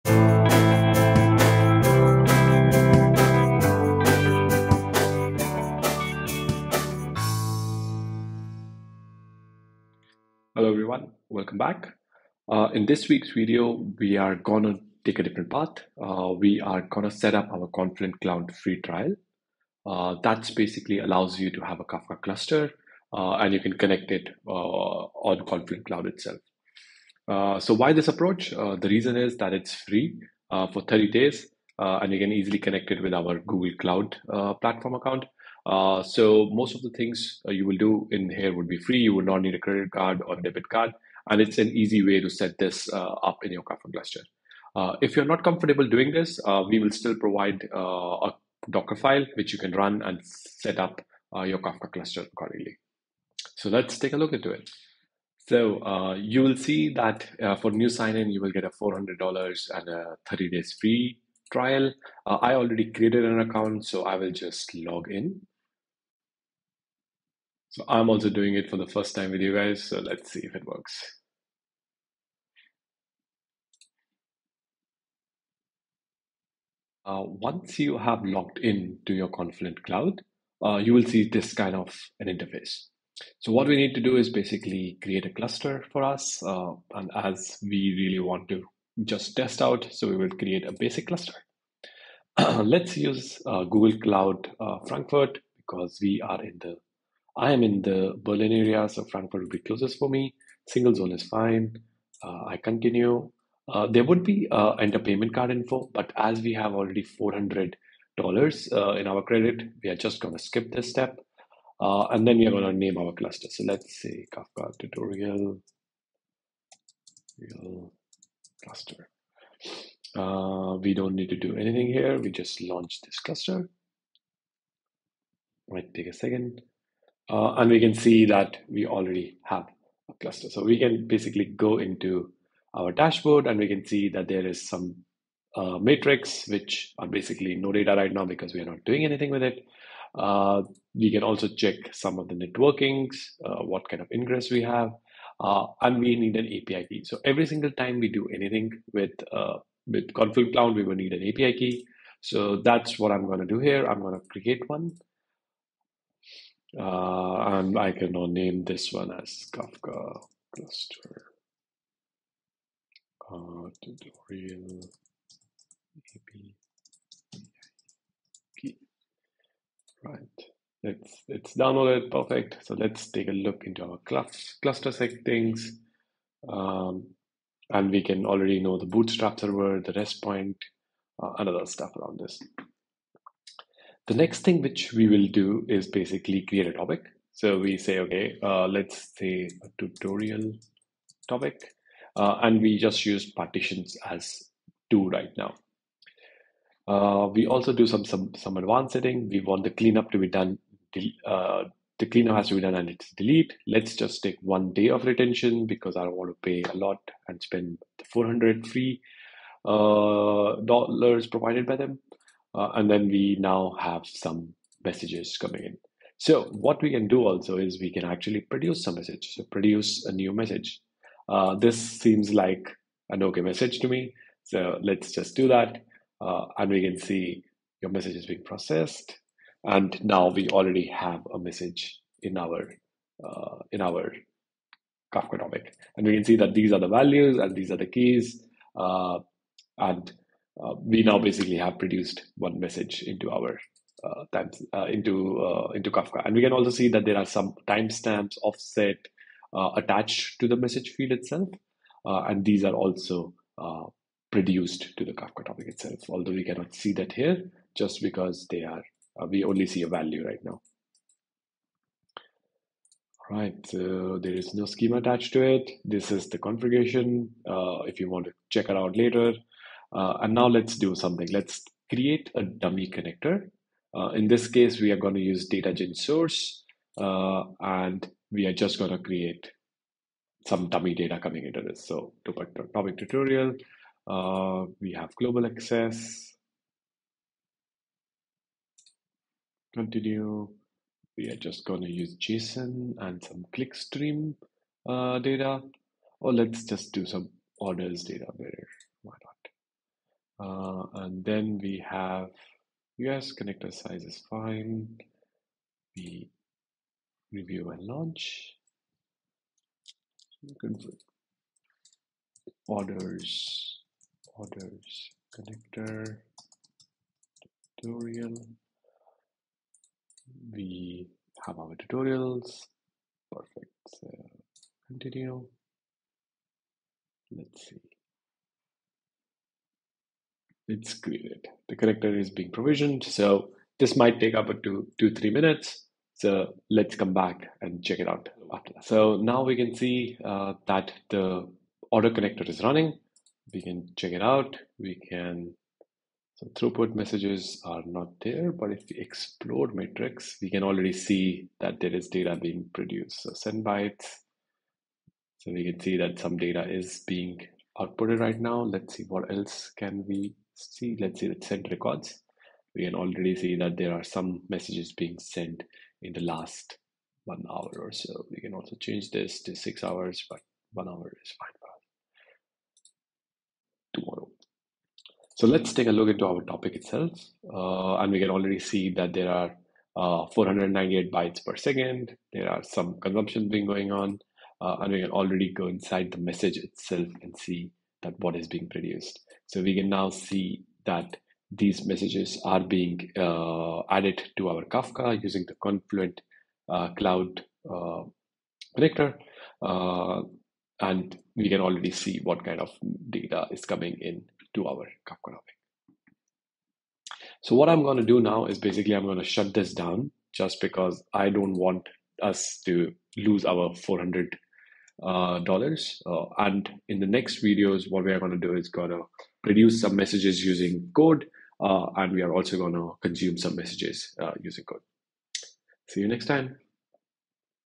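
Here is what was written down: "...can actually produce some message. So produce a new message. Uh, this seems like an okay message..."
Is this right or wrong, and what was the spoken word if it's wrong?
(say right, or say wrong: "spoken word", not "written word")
right.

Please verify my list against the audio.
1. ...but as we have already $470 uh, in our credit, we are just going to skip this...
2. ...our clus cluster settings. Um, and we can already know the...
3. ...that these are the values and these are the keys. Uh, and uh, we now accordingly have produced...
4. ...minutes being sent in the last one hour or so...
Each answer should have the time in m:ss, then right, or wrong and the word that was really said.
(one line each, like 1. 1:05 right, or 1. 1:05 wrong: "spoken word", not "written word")
1. 1:45 wrong: "400", not "470"
2. 2:53 right
3. 3:56 wrong: "basically", not "accordingly"
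4. 6:04 wrong: "messages", not "minutes".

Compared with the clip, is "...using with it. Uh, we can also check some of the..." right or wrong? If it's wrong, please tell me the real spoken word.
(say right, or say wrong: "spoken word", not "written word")
wrong: "anything", not "using".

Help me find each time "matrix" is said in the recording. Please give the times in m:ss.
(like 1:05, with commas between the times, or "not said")
2:15.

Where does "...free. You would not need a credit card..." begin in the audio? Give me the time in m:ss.
0:38.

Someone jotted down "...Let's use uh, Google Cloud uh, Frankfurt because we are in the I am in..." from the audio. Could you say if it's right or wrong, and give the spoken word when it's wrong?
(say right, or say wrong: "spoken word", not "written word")
right.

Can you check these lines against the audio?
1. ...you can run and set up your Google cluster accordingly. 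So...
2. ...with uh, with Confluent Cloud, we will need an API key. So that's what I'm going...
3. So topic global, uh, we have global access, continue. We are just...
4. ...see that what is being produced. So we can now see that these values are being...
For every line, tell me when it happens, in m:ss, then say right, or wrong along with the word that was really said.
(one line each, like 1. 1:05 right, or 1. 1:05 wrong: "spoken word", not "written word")
1. 0:49 wrong: "Kafka", not "Google"
2. 2:28 right
3. 4:41 wrong: "tutorial", not "global"
4. 6:27 wrong: "messages", not "values".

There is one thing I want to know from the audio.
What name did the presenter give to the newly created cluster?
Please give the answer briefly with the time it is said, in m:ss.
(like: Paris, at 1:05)
Kafka tutorial real cluster, at 1:54.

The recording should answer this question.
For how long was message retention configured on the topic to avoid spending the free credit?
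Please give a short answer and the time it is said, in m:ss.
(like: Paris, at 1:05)
1 day, at 3:24.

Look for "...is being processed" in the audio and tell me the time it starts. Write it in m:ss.
3:48.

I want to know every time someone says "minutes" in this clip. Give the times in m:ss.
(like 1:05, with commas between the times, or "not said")
5:35.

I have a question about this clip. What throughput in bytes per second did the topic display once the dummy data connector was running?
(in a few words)
498.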